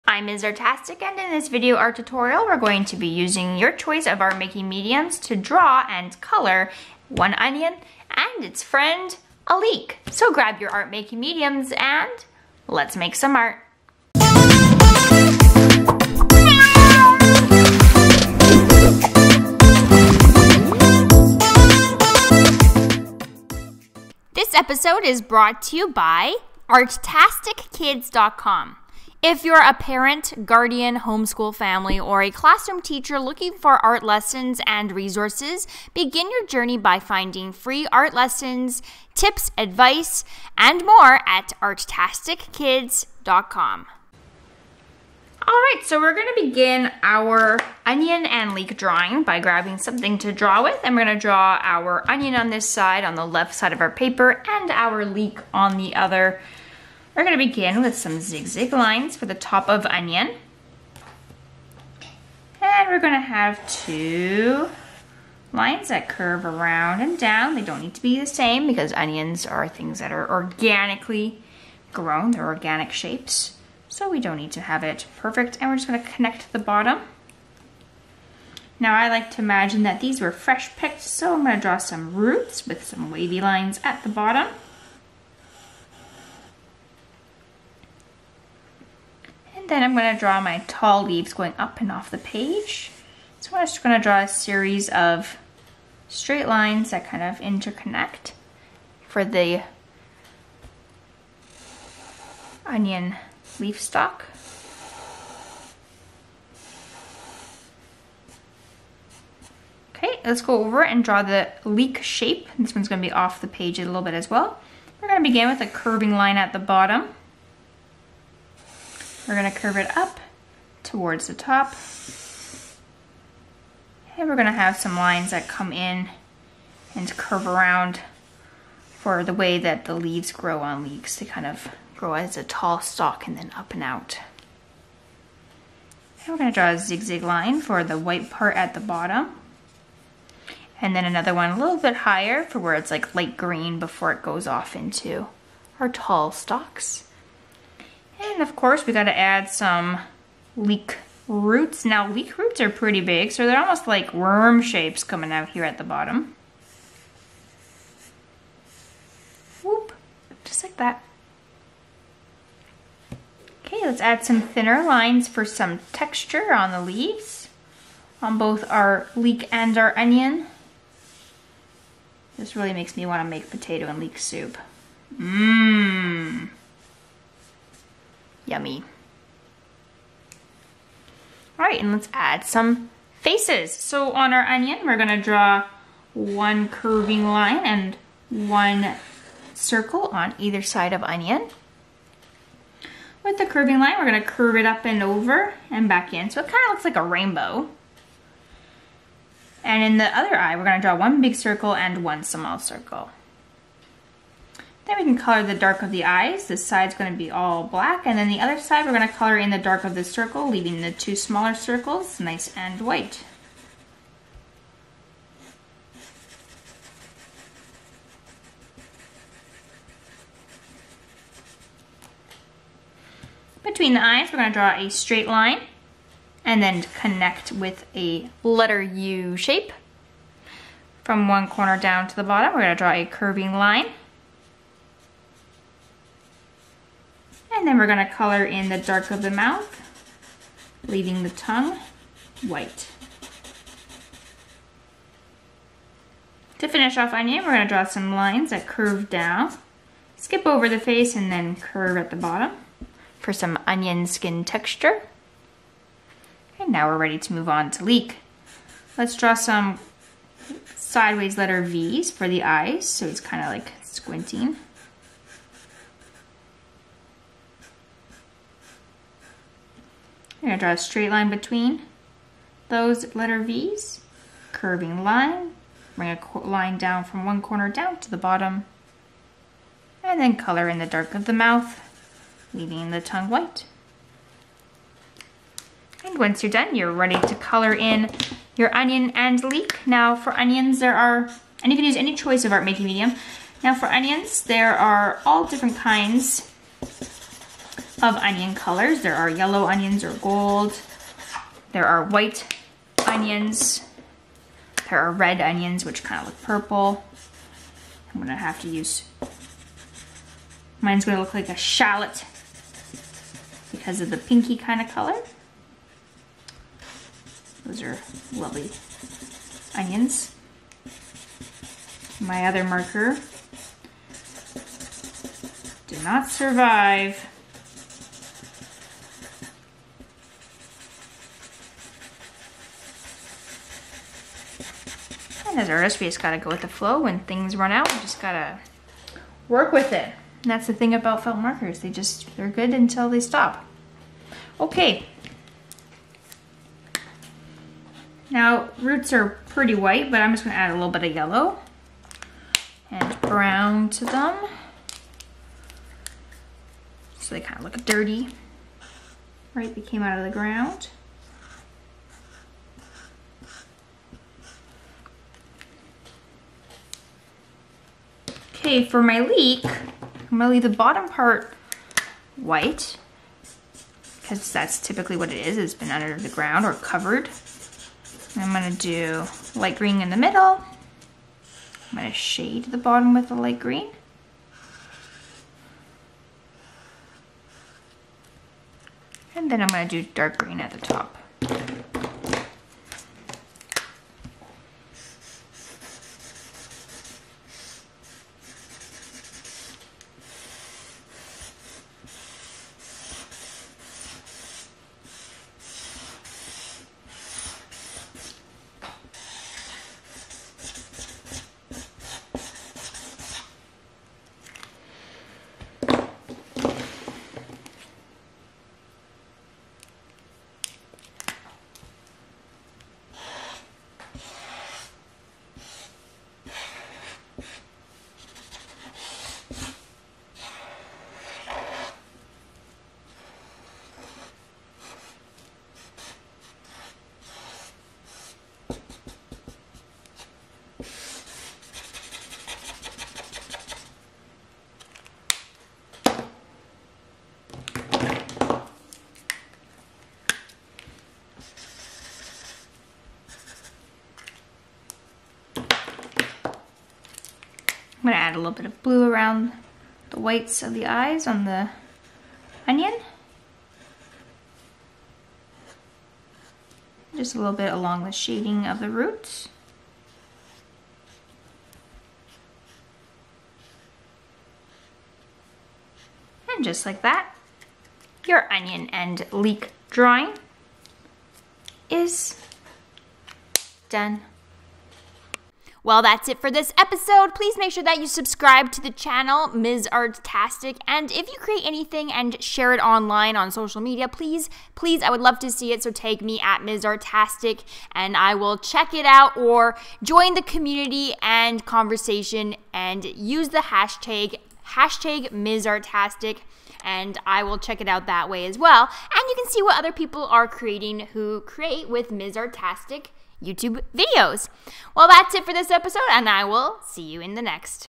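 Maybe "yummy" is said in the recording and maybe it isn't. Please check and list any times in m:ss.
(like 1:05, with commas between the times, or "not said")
2:58.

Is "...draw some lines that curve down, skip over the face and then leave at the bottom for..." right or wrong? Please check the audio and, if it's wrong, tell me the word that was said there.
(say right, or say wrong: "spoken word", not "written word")
wrong: "curve", not "leave".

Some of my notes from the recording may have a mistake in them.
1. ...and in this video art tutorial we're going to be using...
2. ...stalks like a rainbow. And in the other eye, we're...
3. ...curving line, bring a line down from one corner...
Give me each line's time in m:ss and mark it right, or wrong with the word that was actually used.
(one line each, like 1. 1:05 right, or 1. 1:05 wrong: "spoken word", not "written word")
1. 0:01 right
2. 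3:16 wrong: "looks", not "stalks"
3. 4:34 right.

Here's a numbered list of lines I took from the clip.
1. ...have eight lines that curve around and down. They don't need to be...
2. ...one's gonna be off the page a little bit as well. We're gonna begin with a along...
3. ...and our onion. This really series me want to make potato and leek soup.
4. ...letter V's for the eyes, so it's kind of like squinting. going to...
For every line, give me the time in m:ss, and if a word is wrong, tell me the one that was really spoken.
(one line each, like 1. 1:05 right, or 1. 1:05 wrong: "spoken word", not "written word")
1. 1:03 wrong: "two", not "eight"
2. 1:52 wrong: "curving", not "along"
3. 2:49 wrong: "makes", not "series"
4. 4:21 right.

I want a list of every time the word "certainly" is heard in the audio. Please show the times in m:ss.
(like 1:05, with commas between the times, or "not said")
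not said.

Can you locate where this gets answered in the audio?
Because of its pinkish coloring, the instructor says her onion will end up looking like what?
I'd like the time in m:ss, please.
5:11.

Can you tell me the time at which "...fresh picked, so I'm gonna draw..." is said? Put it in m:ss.
1:20.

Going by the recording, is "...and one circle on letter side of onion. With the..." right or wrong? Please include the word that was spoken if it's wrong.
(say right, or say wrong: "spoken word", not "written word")
wrong: "either", not "letter".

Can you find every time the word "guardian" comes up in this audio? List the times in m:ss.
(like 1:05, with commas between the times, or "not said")
0:30.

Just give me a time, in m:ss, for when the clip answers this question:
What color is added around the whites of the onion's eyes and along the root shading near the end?
7:38.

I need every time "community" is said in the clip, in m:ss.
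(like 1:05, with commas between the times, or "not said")
8:20.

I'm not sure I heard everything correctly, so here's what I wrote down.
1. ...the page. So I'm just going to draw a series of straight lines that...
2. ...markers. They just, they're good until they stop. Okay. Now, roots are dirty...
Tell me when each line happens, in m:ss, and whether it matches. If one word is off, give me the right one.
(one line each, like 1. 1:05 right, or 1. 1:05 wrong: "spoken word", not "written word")
1. 1:32 right
2. 5:41 wrong: "pretty", not "dirty".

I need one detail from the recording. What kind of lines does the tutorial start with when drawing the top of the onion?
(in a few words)
Zigzag lines.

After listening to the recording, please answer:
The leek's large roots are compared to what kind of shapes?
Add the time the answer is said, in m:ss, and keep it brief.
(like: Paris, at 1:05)
Worm shapes, at 2:34.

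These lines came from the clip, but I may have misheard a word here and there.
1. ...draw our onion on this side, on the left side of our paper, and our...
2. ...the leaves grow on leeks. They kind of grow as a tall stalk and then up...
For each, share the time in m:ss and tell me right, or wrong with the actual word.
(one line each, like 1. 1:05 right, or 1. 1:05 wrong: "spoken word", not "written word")
1. 0:51 right
2. 2:09 right.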